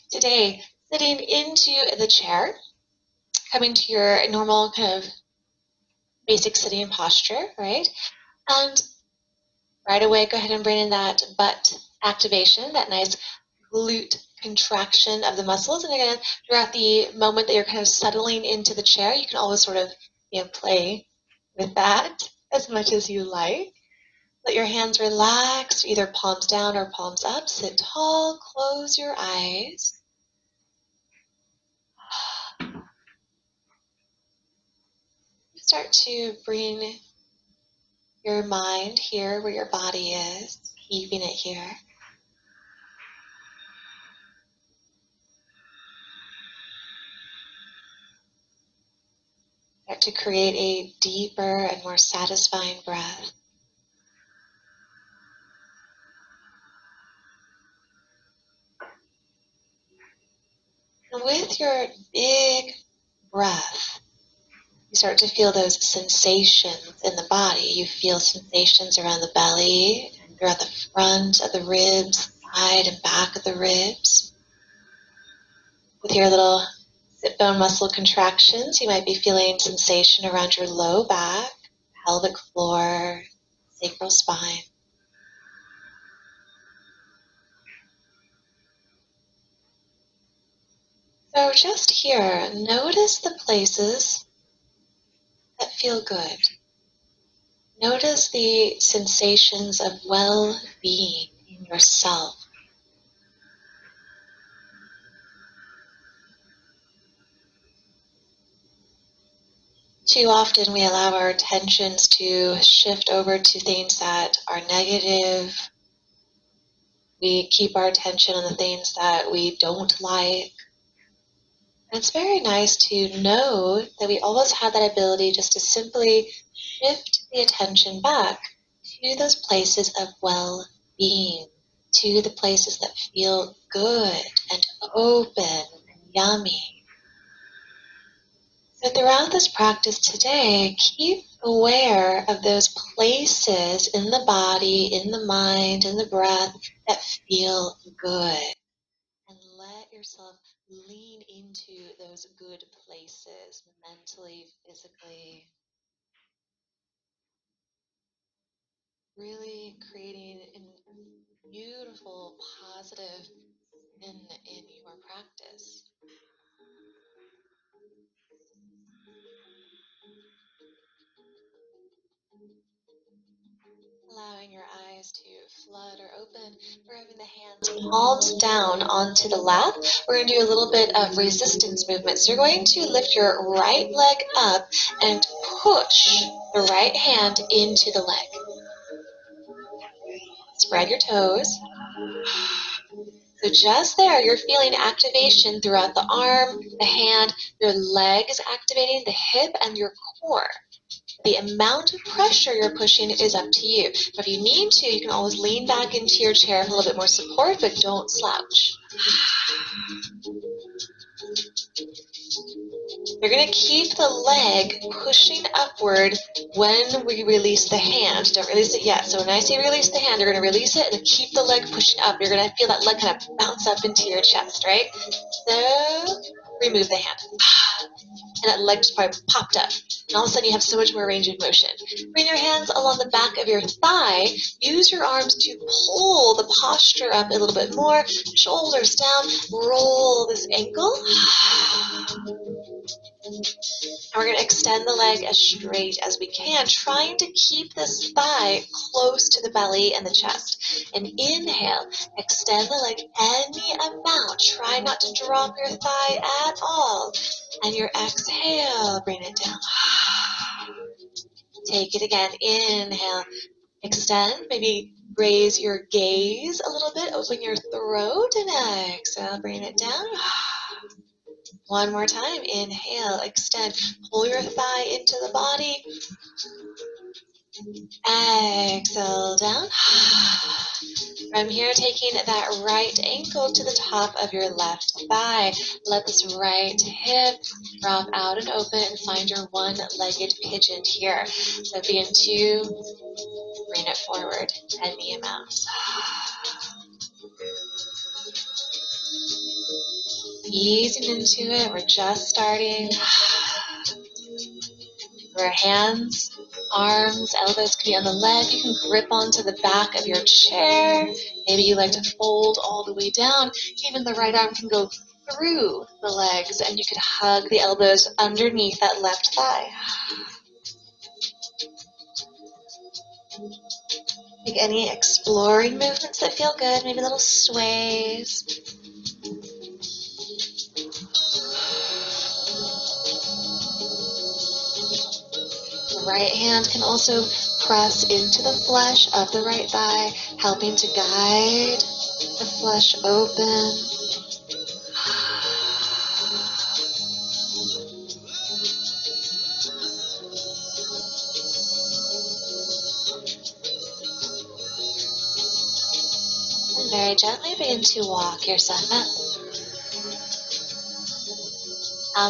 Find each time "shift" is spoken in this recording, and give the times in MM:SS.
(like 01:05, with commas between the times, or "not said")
01:52, 02:06.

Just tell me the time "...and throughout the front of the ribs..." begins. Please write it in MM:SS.
01:10.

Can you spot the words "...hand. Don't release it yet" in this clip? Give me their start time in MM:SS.
03:37.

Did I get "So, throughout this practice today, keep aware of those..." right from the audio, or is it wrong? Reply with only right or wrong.
right.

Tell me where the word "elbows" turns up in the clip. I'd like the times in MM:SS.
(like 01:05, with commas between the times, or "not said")
05:07, 05:17.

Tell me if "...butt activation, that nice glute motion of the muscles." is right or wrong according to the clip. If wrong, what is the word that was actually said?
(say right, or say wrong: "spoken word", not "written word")
wrong: "contraction", not "motion".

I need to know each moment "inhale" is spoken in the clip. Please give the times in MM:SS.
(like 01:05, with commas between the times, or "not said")
04:11, 04:22, 04:32.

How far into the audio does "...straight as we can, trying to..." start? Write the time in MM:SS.
04:05.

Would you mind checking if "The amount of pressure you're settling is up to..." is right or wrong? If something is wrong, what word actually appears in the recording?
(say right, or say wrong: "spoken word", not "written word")
wrong: "pushing", not "settling".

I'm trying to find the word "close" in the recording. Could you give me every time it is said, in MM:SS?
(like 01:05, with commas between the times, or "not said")
00:28, 04:08.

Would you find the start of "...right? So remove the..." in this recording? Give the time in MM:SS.
03:44.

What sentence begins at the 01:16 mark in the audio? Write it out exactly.
With your little Sit bone muscle contractions.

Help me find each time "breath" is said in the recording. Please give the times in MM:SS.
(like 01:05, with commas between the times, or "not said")
00:52, 01:03, 02:26.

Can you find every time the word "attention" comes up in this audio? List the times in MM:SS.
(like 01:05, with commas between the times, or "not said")
01:51, 01:57, 02:07.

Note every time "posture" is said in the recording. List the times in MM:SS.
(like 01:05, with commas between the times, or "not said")
00:06, 03:56.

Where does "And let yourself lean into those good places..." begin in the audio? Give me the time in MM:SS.
02:29.